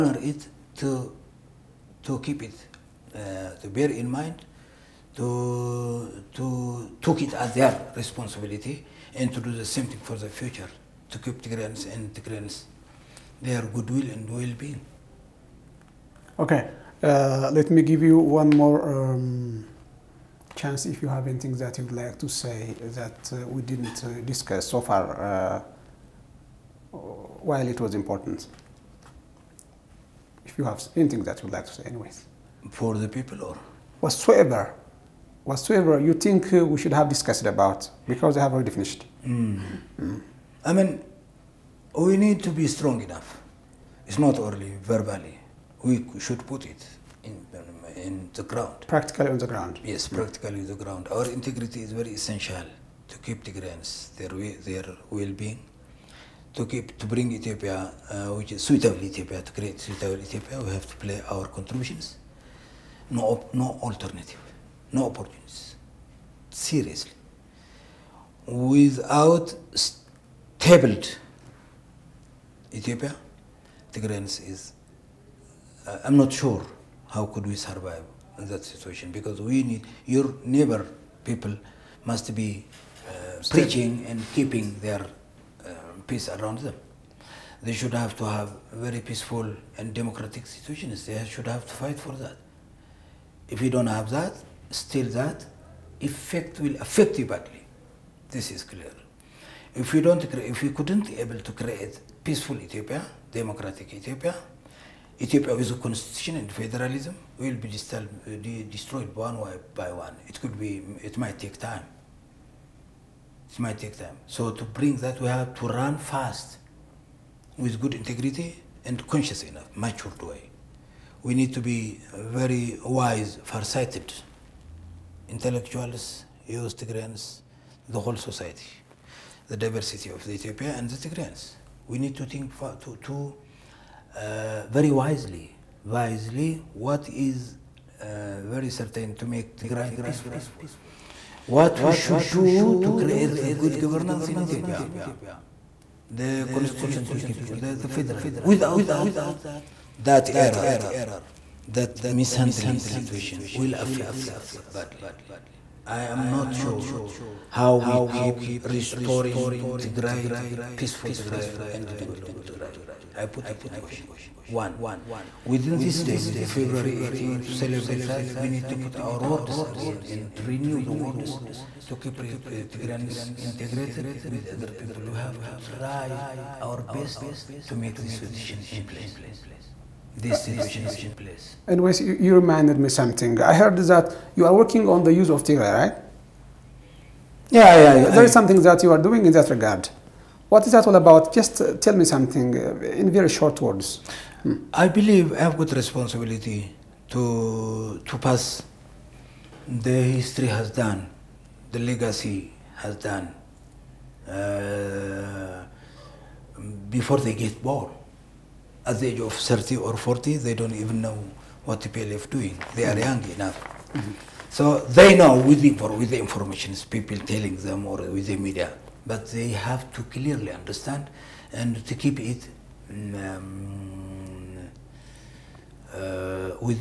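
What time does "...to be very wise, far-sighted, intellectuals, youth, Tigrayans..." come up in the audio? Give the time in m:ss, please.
2:01.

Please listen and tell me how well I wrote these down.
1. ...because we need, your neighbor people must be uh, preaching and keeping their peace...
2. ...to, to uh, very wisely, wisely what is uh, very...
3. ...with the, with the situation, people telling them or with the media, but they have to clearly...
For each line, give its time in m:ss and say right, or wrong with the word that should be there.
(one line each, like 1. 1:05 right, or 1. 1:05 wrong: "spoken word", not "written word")
1. 1:19 right
2. 2:12 right
3. 3:35 wrong: "information", not "situation".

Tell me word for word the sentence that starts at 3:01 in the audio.
And you, you reminded me something.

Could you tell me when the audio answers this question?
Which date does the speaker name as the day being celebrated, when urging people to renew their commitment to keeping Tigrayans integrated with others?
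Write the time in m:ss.
2:46.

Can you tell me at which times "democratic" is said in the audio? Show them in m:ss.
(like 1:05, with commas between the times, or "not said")
1:29, 1:43.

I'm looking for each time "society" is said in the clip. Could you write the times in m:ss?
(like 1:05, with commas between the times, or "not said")
2:08.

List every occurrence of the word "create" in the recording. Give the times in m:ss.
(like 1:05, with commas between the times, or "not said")
0:59, 1:41, 2:22.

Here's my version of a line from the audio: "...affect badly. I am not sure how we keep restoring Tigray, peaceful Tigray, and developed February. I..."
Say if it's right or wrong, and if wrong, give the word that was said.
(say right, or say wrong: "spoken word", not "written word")
wrong: "Tigray", not "February".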